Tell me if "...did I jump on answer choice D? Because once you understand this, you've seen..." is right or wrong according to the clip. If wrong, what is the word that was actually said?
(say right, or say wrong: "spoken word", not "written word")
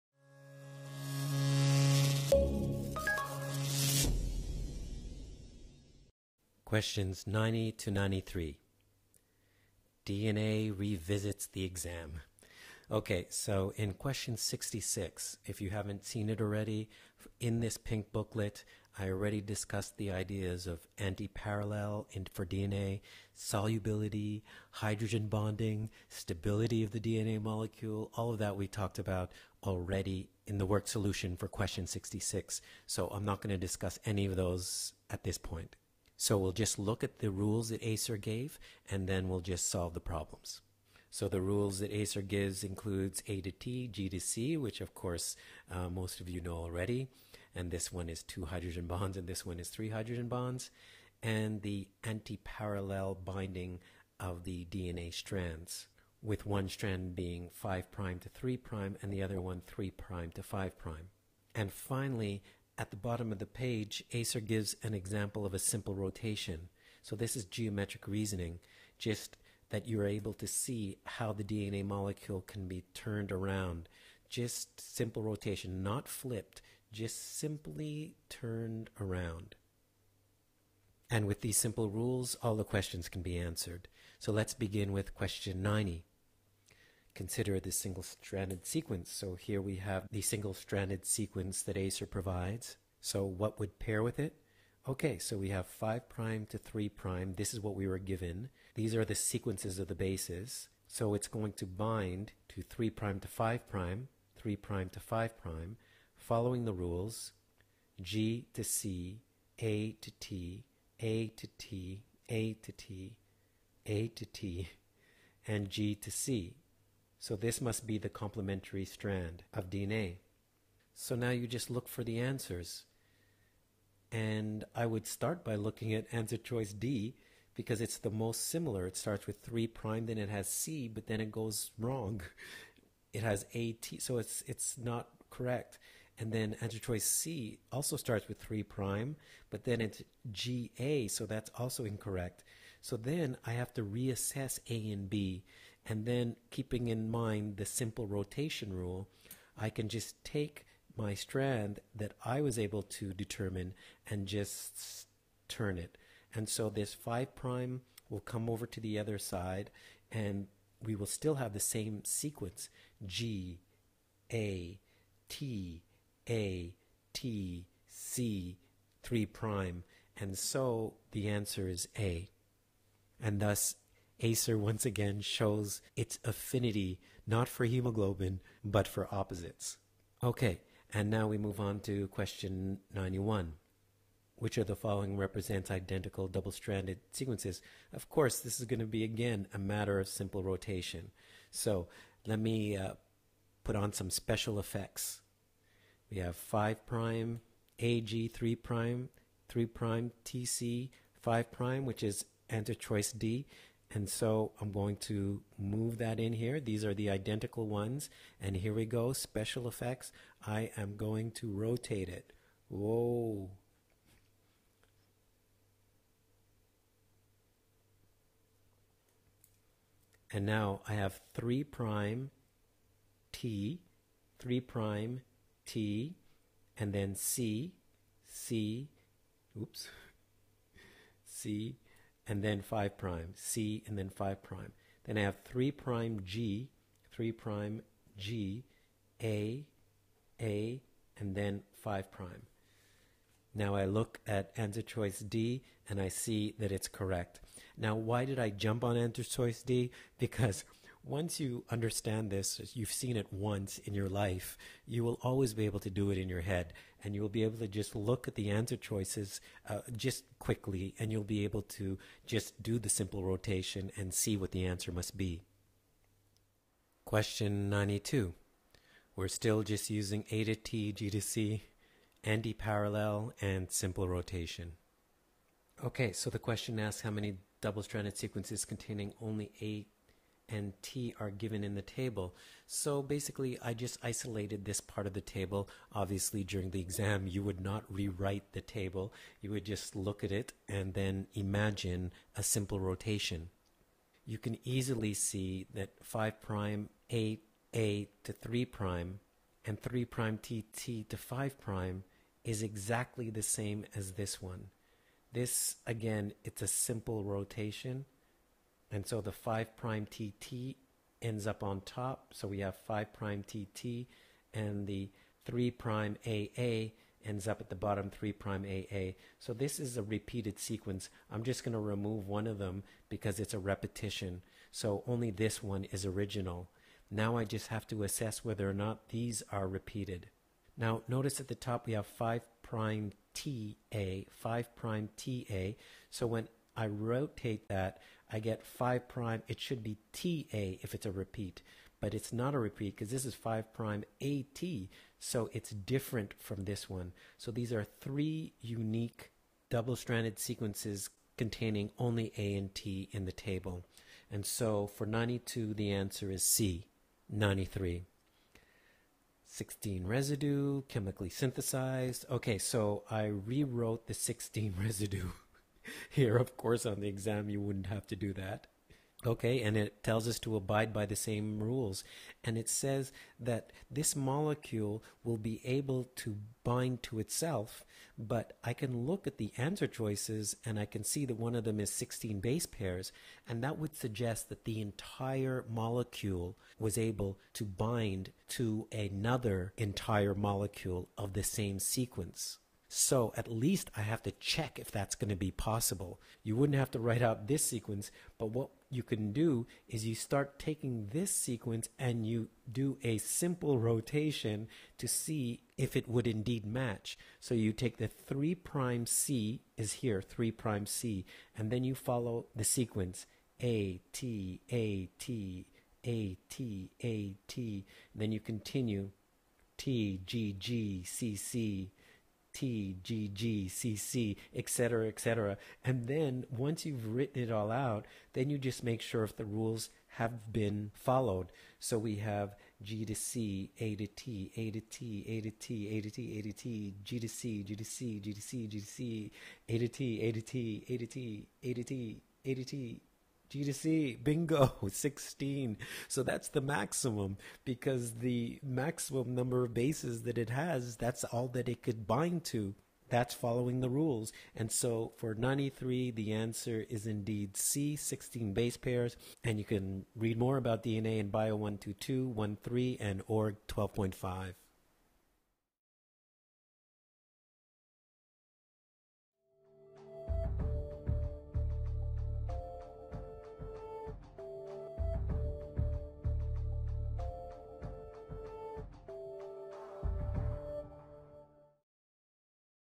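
right.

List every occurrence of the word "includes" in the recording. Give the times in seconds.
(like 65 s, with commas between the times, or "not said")
42 s.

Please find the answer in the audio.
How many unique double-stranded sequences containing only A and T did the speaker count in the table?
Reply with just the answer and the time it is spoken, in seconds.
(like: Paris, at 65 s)
3, at 347 s.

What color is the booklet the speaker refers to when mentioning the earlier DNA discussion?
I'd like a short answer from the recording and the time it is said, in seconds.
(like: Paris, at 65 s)
pink, at 17 s.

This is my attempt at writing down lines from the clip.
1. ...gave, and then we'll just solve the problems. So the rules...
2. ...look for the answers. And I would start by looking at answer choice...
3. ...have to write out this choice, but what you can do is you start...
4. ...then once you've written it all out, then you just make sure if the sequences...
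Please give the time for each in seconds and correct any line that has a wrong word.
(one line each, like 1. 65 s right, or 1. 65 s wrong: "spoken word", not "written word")
1. 38 s right
2. 121 s right
3. 396 s wrong: "sequence", not "choice"
4. 426 s wrong: "rules", not "sequences".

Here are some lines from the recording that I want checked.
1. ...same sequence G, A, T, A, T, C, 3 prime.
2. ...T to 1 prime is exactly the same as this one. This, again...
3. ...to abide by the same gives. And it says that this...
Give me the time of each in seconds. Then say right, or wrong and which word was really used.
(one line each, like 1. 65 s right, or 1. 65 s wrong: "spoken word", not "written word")
1. 161 s right
2. 300 s wrong: "5", not "1"
3. 370 s wrong: "rules", not "gives".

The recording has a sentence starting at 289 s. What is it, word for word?
You would just look at it and then imagine a simple rotation.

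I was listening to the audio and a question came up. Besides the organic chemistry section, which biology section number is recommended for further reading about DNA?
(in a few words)
Bio 12.13.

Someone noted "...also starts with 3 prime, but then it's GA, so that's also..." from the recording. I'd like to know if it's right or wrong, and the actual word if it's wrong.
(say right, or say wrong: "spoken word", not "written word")
right.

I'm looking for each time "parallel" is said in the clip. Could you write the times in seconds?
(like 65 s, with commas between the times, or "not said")
20 s, 52 s, 272 s.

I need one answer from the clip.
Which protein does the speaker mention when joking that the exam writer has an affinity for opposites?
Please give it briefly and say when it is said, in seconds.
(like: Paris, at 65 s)
hemoglobin, at 177 s.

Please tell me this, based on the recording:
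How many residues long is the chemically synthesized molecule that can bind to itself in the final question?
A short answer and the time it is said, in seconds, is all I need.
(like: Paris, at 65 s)
16, at 359 s.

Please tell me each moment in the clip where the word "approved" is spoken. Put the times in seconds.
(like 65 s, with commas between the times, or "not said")
not said.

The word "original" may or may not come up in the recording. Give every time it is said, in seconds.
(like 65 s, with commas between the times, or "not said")
326 s.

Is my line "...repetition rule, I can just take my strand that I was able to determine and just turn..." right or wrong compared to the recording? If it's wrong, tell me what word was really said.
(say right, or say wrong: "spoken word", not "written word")
wrong: "rotation", not "repetition".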